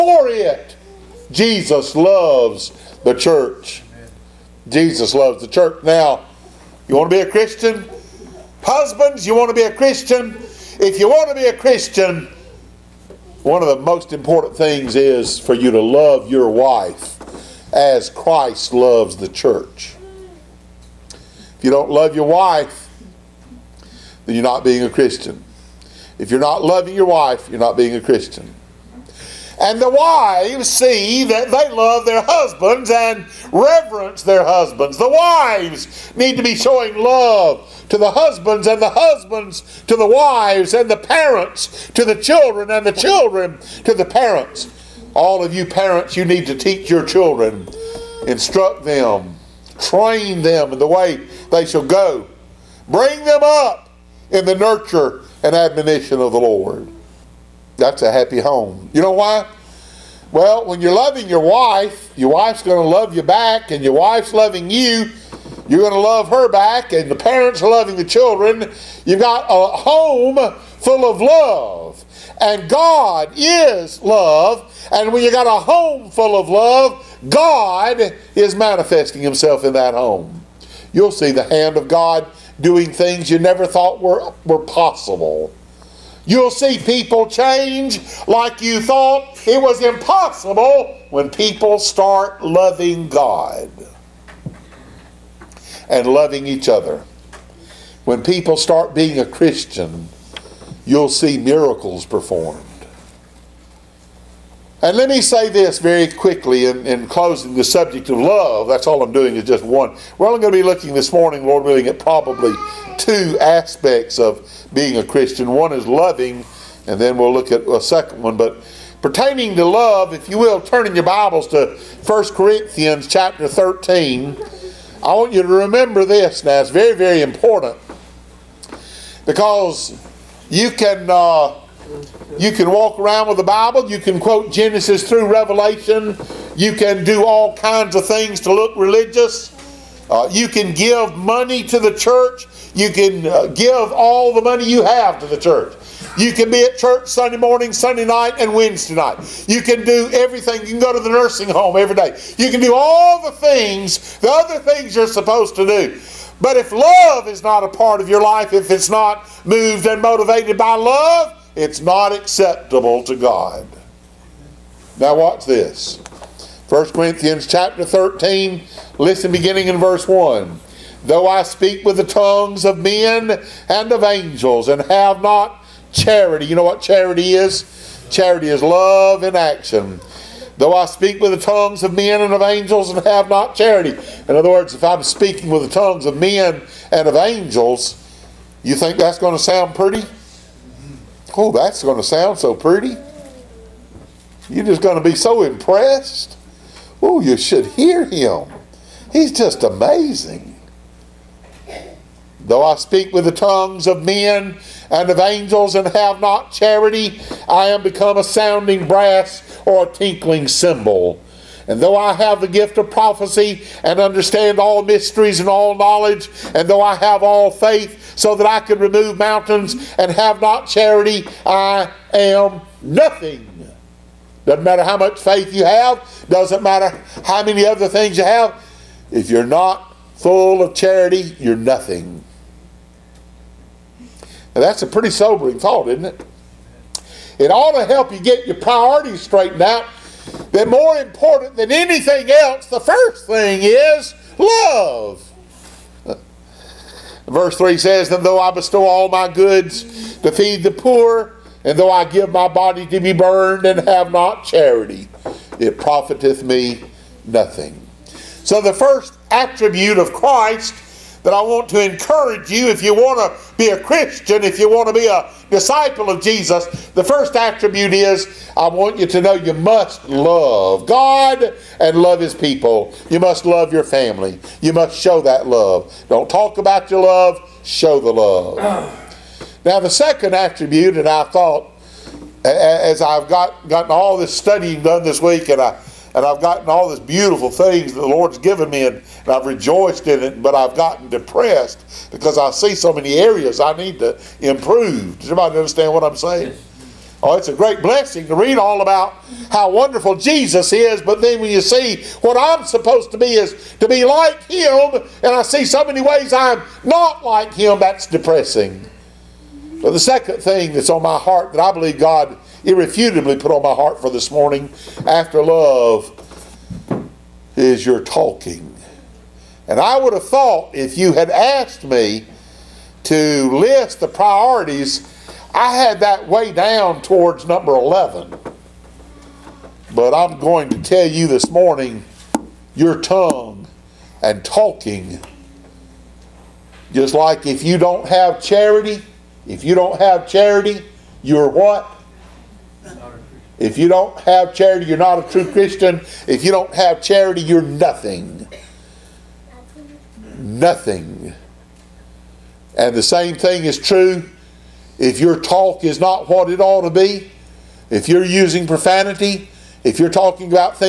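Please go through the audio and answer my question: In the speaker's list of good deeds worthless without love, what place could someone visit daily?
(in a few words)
Nursing home.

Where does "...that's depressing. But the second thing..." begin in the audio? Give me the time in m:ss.
5:07.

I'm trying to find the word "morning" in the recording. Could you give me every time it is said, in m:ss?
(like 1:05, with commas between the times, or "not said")
1:51, 2:27, 5:14, 5:31.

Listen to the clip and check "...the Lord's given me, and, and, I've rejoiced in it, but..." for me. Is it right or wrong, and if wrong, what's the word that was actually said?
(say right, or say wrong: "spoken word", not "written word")
right.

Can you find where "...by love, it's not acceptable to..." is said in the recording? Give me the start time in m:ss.
2:40.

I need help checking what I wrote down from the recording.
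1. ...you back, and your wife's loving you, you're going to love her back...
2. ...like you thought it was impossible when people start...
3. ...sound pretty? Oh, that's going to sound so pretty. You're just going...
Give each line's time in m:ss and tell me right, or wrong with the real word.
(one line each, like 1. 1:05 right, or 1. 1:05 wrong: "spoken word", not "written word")
1. 1:03 right
2. 1:28 right
3. 3:09 right.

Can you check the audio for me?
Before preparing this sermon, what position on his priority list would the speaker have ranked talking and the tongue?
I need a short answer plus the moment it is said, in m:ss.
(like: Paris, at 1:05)
11, at 5:27.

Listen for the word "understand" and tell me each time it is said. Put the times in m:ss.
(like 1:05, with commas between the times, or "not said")
3:33, 4:55.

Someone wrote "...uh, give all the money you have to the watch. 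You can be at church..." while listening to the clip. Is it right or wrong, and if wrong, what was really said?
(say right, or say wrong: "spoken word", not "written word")
wrong: "church", not "watch".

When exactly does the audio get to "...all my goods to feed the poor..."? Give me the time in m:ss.
4:08.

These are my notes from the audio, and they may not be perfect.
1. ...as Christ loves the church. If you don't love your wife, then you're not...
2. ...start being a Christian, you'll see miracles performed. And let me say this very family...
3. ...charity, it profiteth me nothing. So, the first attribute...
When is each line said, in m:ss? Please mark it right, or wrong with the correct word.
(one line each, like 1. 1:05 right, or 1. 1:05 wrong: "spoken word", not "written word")
1. 0:17 right
2. 1:38 wrong: "quickly", not "family"
3. 4:14 right.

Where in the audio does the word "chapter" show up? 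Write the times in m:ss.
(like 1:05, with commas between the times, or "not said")
2:03, 2:47.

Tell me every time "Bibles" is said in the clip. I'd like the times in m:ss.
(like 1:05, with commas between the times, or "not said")
2:01, 2:13.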